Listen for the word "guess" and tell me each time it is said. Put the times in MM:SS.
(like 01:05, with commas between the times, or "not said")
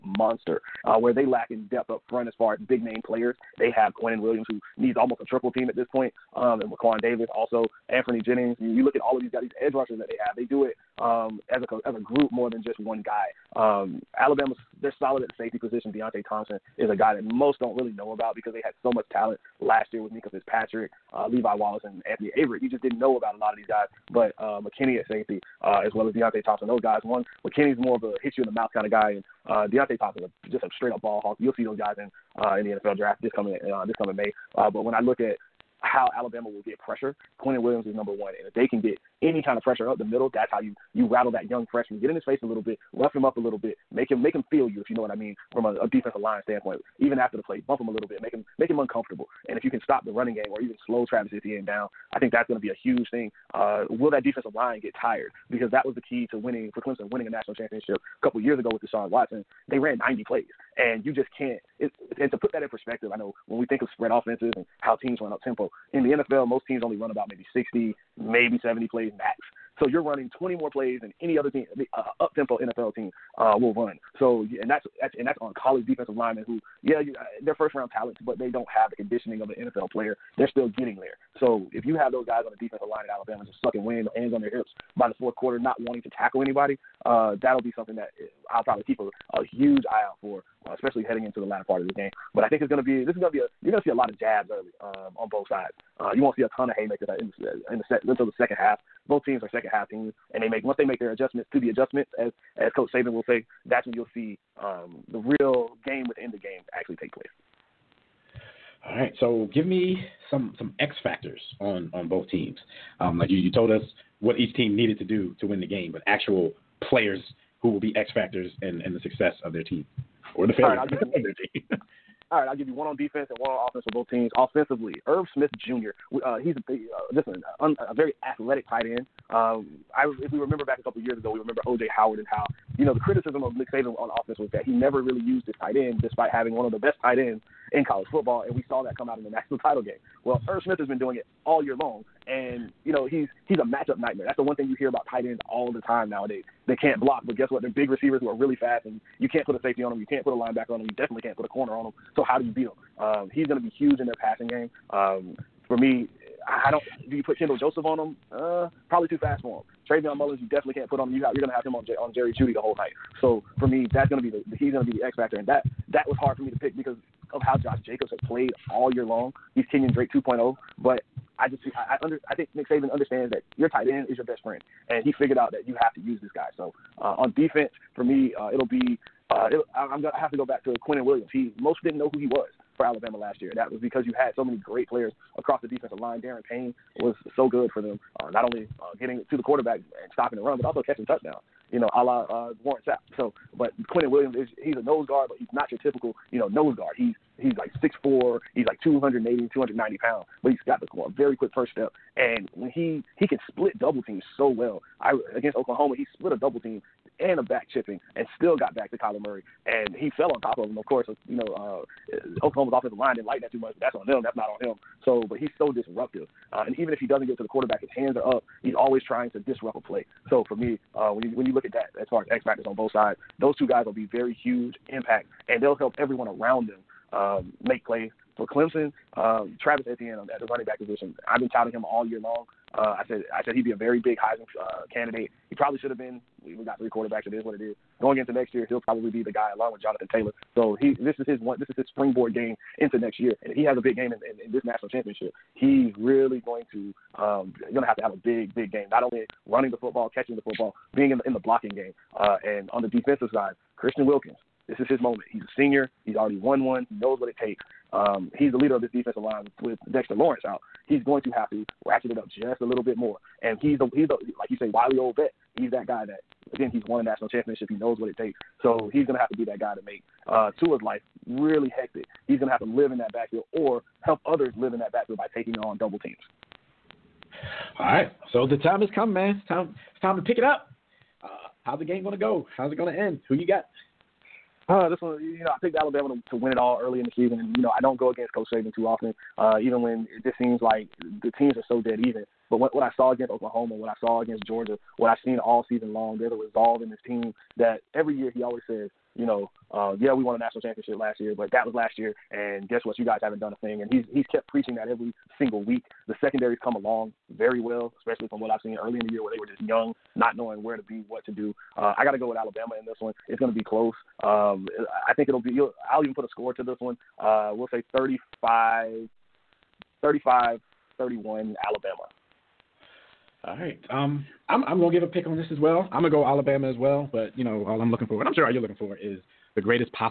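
02:27, 05:02.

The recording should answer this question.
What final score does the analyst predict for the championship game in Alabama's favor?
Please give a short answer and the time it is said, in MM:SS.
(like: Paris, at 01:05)
35-31, at 05:20.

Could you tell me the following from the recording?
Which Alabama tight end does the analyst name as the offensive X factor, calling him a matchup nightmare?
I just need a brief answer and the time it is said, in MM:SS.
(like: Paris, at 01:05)
Irv Smith Jr., at 02:05.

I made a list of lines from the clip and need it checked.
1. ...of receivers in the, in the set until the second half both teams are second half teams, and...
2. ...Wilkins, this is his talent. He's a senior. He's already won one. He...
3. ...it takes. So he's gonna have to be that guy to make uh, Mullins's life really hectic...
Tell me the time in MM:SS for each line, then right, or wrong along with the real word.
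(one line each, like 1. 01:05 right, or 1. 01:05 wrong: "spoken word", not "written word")
1. 01:36 wrong: "haymakers", not "receivers"
2. 04:14 wrong: "moment", not "talent"
3. 04:28 wrong: "Tua", not "Mullins".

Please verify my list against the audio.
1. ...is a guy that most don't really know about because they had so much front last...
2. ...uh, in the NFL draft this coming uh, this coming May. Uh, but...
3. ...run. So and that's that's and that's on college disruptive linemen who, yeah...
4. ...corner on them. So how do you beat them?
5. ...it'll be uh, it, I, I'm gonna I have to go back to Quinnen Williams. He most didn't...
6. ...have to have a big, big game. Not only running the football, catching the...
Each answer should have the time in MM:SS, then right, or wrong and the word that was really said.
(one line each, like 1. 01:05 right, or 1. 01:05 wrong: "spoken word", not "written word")
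1. 00:16 wrong: "talent", not "front"
2. 00:32 right
3. 01:13 wrong: "defensive", not "disruptive"
4. 02:31 right
5. 02:58 right
6. 04:07 right.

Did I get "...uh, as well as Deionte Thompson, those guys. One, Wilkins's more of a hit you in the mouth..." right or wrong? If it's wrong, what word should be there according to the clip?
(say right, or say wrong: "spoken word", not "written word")
wrong: "McKinney", not "Wilkins".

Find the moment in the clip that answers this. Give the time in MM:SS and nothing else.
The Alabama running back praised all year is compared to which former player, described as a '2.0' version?
02:49.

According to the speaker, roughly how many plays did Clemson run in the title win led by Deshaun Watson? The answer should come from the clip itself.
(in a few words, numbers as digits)
90.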